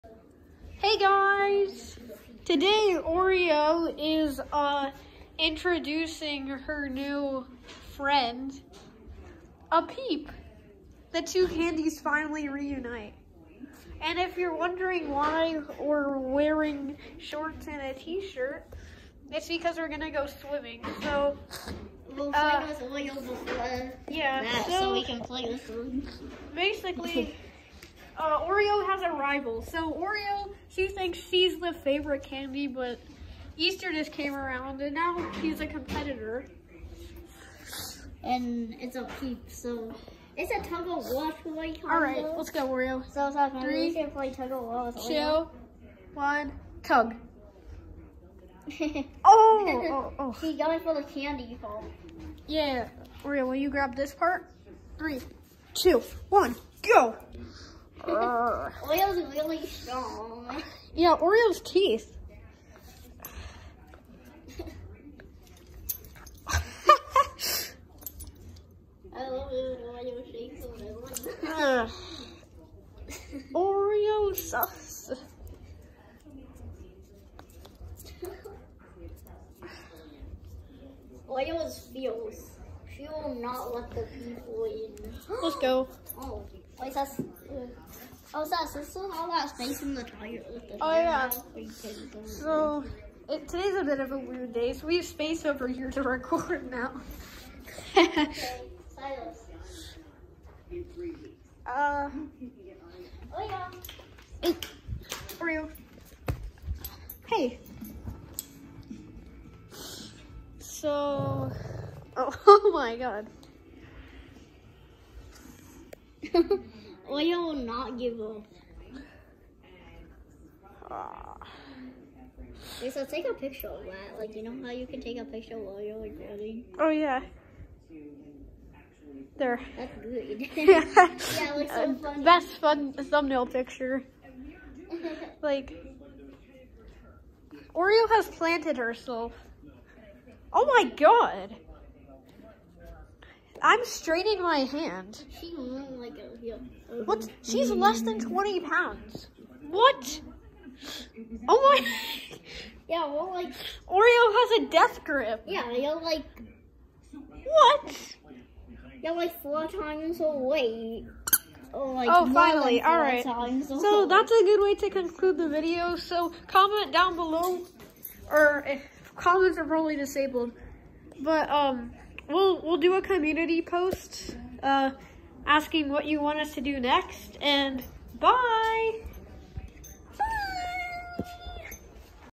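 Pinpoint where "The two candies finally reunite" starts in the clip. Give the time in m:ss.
0:11.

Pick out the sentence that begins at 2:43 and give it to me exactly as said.
So that's a good way to conclude the video.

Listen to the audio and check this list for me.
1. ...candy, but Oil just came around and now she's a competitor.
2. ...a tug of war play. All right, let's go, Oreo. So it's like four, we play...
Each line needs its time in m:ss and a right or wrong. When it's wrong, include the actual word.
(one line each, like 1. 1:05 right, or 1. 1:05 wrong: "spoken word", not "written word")
1. 0:32 wrong: "Easter", not "Oil"
2. 0:40 wrong: "three", not "four".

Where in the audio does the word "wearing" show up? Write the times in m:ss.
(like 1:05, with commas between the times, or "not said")
0:16.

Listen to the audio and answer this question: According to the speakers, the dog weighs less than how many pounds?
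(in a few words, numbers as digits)
20.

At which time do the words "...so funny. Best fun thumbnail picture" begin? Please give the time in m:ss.
2:11.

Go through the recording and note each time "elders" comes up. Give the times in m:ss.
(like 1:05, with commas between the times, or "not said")
not said.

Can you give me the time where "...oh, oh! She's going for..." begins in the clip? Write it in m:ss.
0:49.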